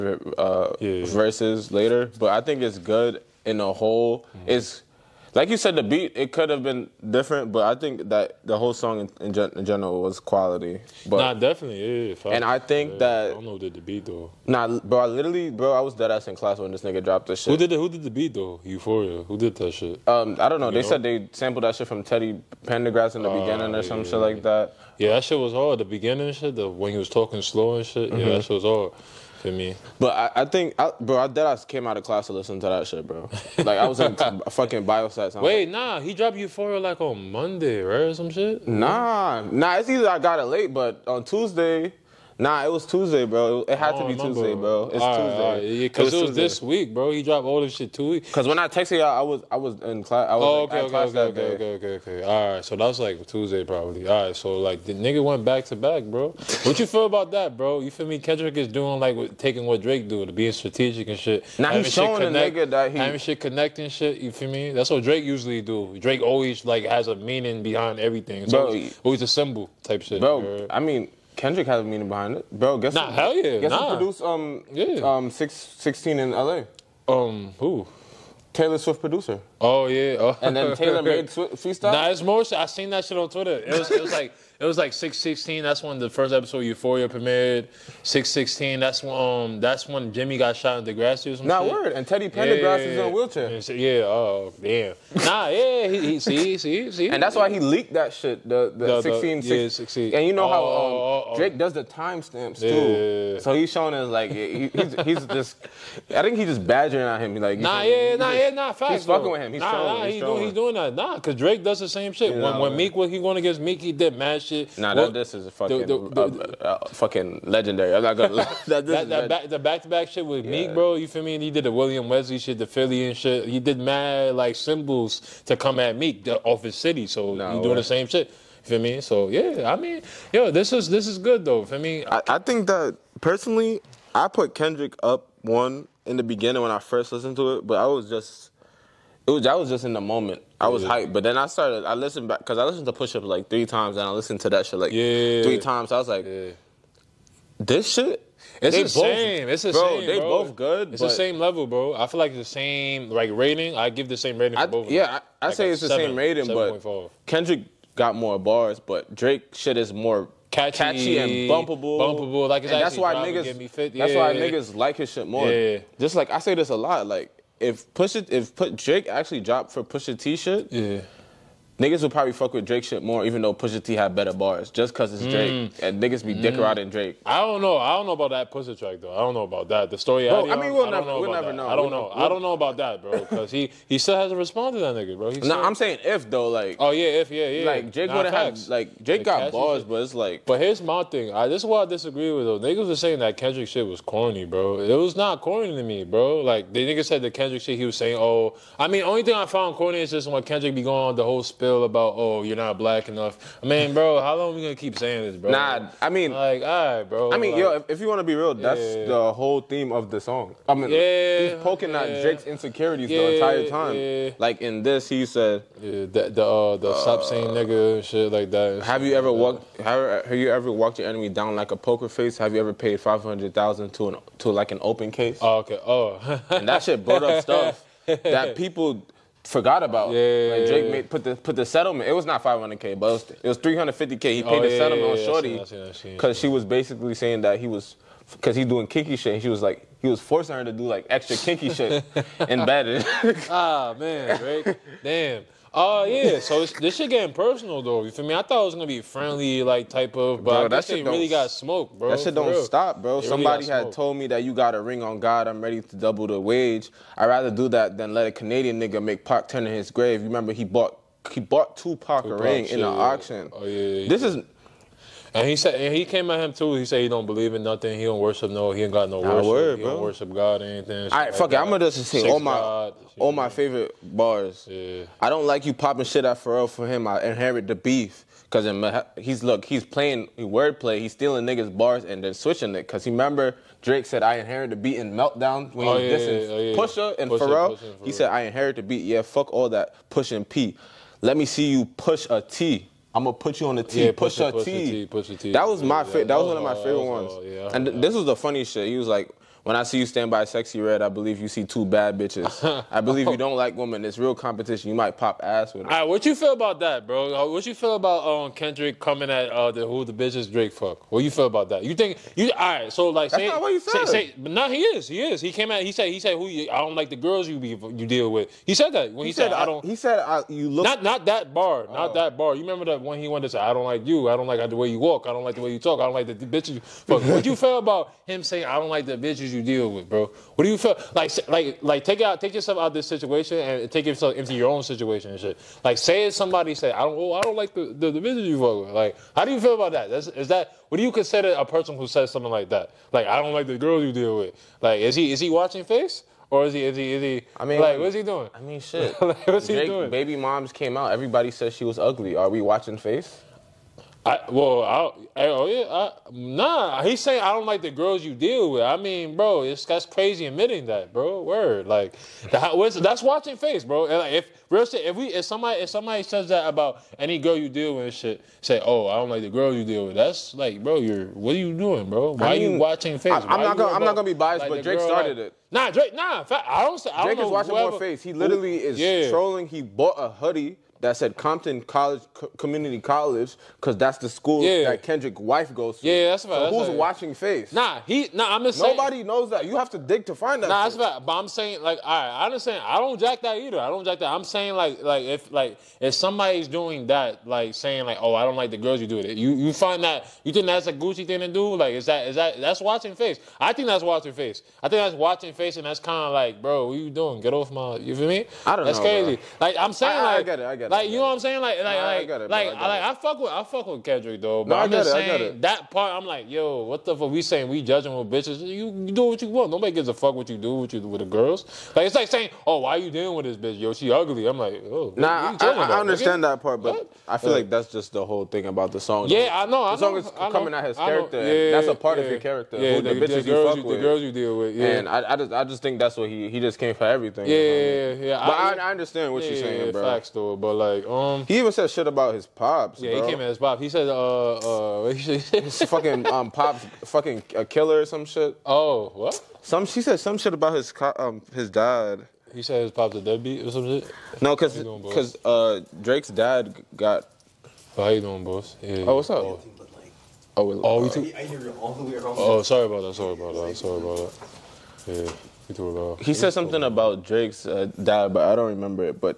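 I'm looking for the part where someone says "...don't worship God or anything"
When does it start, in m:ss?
4:29.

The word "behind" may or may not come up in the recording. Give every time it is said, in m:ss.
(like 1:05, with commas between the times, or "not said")
1:07, 1:12.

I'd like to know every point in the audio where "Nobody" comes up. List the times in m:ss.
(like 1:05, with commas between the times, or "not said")
6:28, 6:59.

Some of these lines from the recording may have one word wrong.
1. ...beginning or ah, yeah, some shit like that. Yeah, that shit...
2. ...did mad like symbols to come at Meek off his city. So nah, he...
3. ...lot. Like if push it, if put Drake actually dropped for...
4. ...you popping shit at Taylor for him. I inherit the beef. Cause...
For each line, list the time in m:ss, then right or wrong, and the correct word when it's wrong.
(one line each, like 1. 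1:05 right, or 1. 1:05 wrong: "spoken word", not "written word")
1. 0:23 right
2. 2:03 right
3. 2:46 right
4. 4:35 wrong: "Pharrell", not "Taylor".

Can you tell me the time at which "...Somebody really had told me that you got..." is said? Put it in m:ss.
4:13.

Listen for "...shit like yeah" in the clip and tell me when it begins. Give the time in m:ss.
2:24.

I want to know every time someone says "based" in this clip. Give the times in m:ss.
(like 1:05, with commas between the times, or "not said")
not said.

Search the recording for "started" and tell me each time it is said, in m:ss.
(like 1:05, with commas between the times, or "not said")
2:21, 6:15.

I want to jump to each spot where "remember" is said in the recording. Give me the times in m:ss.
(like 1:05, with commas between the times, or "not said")
0:44, 4:20, 4:43, 5:22, 7:48.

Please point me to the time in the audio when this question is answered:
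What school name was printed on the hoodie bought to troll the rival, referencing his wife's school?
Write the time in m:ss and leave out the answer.
6:21.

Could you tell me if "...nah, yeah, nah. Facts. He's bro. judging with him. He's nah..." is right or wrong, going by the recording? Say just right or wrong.
wrong.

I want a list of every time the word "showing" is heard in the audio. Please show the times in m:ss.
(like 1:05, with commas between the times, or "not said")
1:01, 1:43, 1:49.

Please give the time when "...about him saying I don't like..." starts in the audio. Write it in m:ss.
5:27.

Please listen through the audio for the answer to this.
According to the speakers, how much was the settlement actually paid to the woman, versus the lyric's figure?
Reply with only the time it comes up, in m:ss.
3:53.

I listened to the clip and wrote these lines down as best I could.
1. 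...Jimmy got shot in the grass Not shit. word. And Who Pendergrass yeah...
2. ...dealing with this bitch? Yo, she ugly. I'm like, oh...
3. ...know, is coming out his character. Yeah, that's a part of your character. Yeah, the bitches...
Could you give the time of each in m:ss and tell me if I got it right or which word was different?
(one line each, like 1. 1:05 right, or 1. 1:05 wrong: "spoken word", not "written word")
1. 1:30 wrong: "Teddy", not "Who"
2. 7:03 right
3. 7:10 right.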